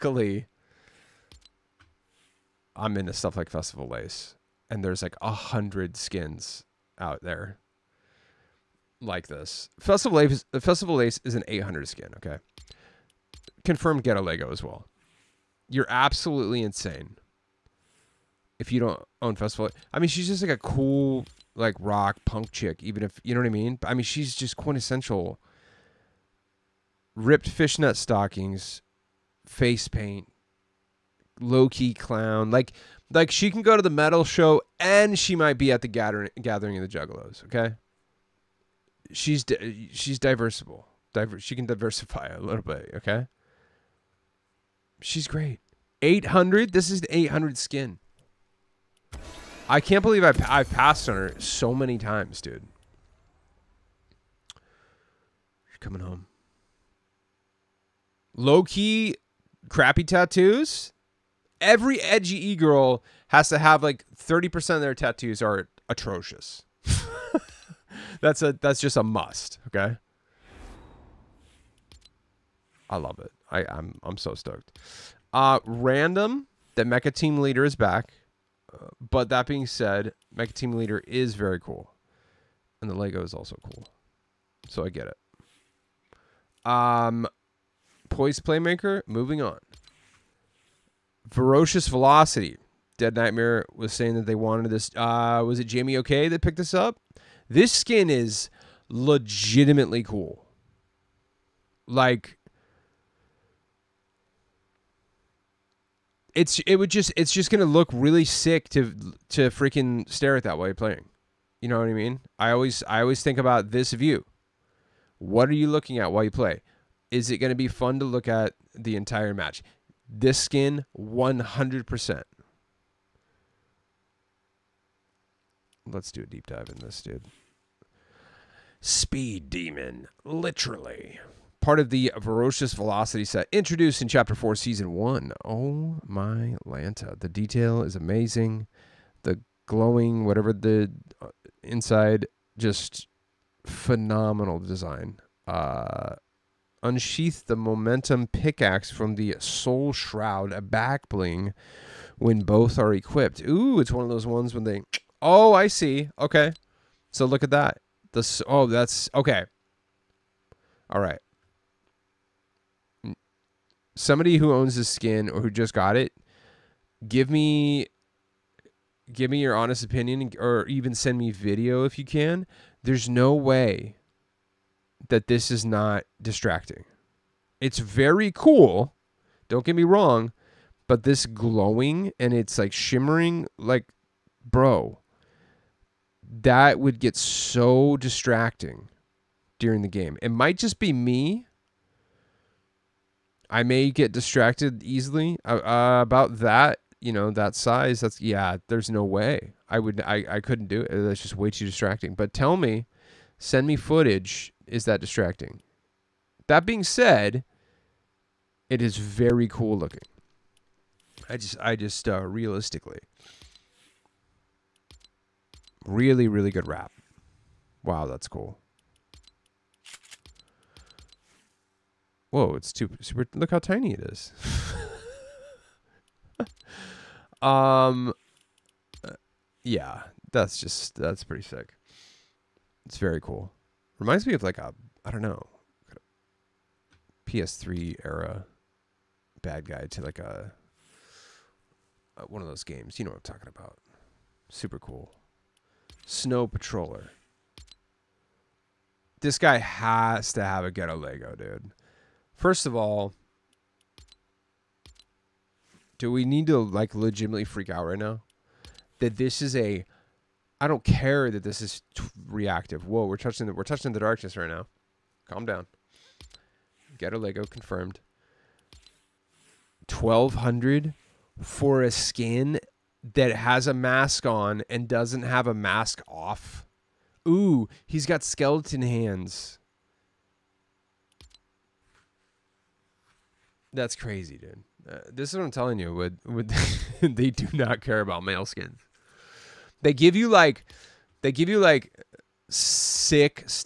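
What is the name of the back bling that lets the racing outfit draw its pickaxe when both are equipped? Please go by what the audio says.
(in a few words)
Soul Shroud.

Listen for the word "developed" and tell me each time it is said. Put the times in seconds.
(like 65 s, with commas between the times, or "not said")
not said.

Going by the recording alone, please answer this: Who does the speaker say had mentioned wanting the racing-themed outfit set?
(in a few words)
Dead Nightmare.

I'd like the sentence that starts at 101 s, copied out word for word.
Like It's it would just it's just gonna look really sick to to freaking stare at that while you're playing.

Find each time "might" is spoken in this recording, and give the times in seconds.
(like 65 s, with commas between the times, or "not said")
35 s, 190 s.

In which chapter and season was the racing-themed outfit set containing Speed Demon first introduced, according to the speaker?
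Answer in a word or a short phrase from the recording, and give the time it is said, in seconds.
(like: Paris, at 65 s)
Chapter 4, Season 1, at 134 s.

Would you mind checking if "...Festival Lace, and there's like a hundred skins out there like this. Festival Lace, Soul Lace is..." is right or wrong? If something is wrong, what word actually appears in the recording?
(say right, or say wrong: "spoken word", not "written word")
wrong: "Festival", not "Soul".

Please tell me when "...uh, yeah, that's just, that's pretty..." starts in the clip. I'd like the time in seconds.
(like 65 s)
229 s.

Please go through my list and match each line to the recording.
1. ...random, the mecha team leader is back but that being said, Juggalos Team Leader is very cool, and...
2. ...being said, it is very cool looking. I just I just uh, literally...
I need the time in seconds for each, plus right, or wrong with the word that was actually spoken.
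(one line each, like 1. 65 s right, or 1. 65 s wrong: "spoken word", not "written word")
1. 75 s wrong: "Mecha", not "Juggalos"
2. 206 s wrong: "realistically", not "literally".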